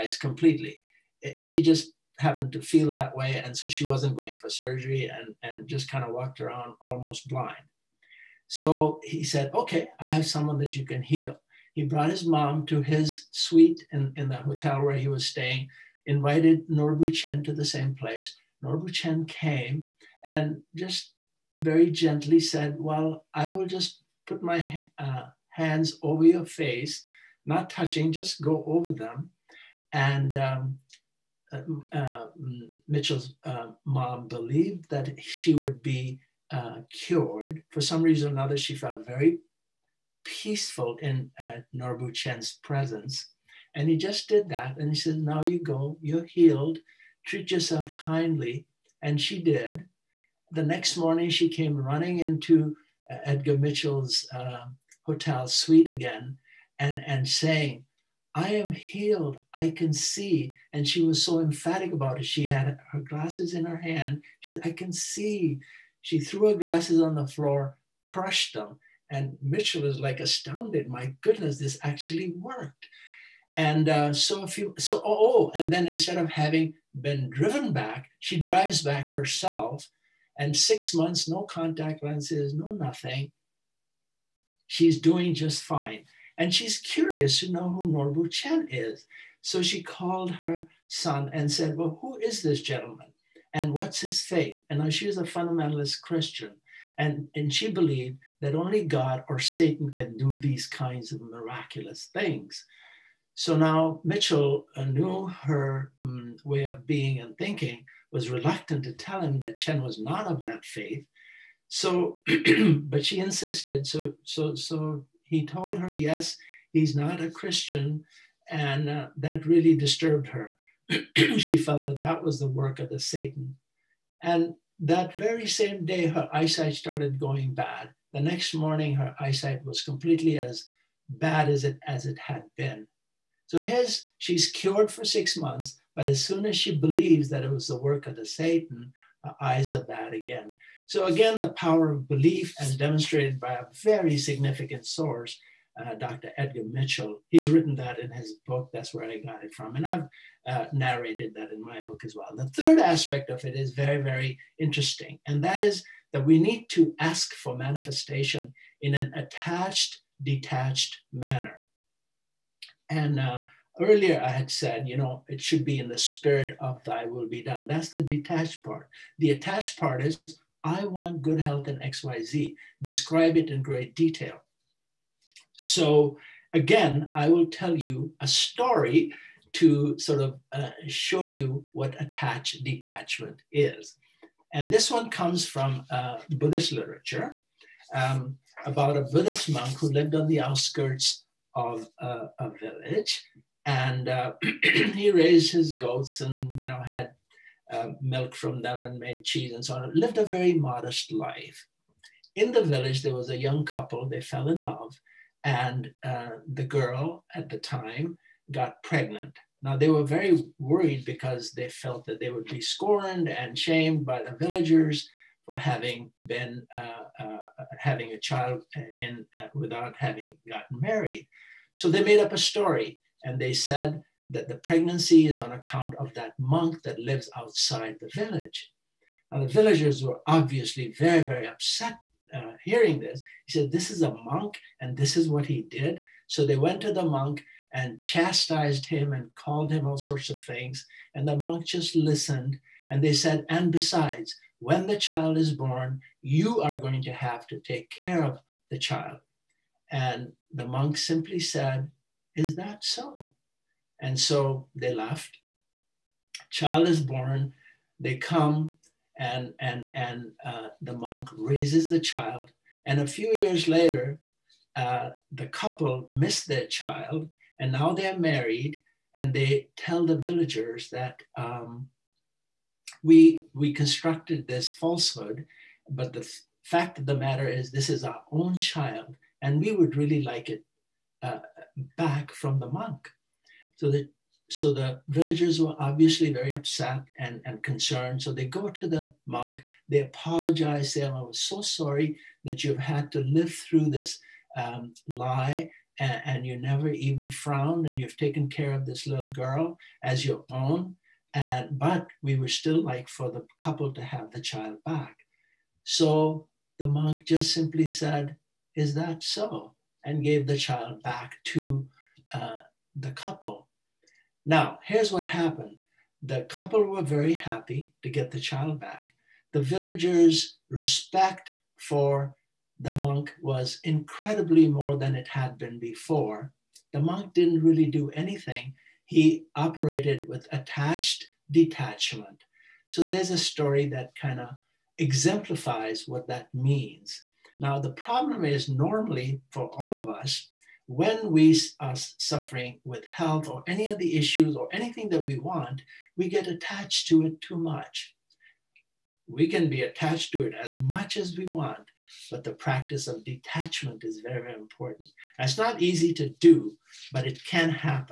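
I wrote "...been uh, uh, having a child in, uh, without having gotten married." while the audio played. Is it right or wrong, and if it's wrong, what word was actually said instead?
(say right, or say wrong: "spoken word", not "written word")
right.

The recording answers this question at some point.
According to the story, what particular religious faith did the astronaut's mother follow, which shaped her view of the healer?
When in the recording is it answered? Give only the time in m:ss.
1:35.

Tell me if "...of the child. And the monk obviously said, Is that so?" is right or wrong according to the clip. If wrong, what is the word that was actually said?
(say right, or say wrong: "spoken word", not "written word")
wrong: "simply", not "obviously".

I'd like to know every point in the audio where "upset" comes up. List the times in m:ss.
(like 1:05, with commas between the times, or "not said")
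3:51, 4:46.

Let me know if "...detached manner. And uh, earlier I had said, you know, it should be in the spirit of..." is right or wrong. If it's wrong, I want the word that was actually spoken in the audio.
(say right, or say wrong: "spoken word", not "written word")
right.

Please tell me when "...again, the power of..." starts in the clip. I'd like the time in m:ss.
2:21.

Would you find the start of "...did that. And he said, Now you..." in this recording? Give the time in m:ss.
0:44.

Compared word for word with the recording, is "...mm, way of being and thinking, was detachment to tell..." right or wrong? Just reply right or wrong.
wrong.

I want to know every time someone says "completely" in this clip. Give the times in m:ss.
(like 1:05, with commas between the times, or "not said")
0:00, 2:09.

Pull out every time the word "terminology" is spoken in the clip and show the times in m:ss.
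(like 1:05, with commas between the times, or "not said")
not said.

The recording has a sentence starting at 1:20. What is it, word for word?
And six months, no contact lenses, no nothing.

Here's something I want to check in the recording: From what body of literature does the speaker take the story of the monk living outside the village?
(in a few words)
Buddhist literature.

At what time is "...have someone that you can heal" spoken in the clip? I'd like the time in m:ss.
0:10.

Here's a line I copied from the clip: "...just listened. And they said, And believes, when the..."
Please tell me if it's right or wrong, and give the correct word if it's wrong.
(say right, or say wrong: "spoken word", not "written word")
wrong: "besides", not "believes".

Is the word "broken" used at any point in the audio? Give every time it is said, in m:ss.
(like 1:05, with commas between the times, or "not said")
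not said.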